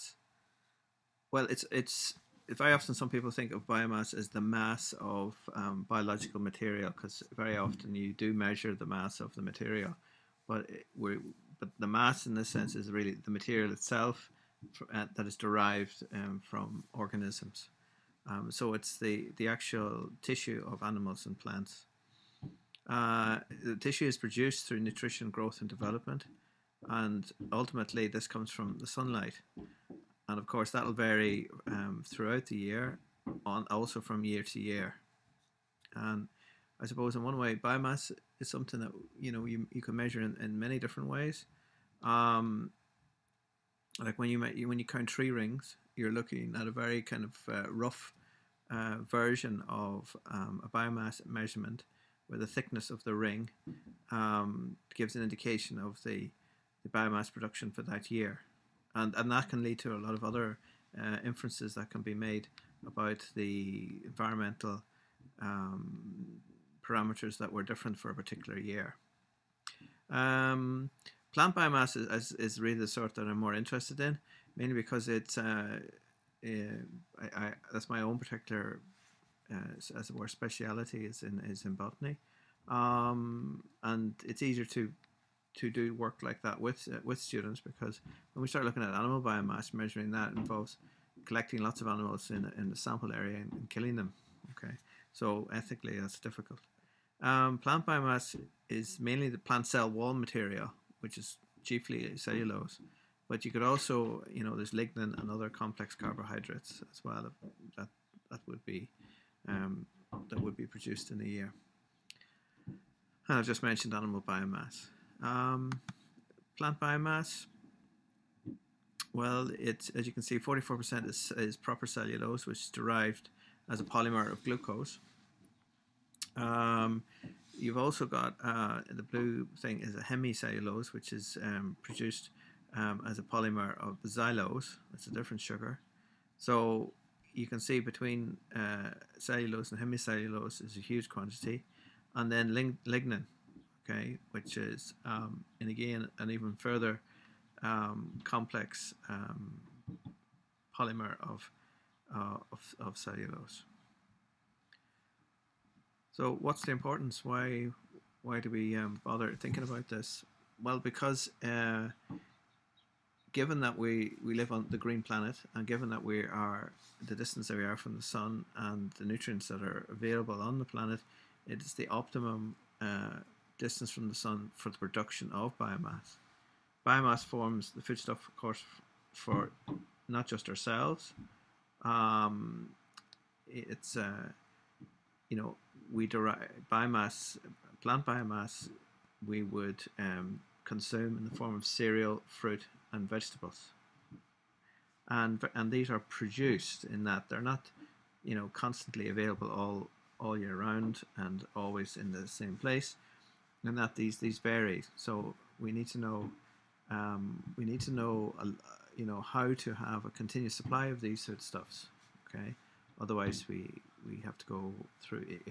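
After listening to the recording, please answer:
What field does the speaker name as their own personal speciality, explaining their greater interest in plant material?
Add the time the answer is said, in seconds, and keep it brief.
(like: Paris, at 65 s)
Botany, at 81 s.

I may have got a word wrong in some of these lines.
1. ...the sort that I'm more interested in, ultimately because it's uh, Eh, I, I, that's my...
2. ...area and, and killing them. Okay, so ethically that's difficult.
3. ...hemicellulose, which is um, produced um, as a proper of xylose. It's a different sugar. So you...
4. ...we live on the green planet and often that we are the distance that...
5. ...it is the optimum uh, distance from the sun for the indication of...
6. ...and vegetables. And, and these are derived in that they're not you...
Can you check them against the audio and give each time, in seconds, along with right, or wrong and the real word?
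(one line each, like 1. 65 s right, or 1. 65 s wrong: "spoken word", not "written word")
1. 72 s wrong: "mainly", not "ultimately"
2. 93 s right
3. 129 s wrong: "polymer", not "proper"
4. 164 s wrong: "given", not "often"
5. 171 s wrong: "production", not "indication"
6. 192 s wrong: "produced", not "derived".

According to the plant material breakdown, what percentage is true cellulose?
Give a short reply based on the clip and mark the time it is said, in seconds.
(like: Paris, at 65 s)
44%, at 120 s.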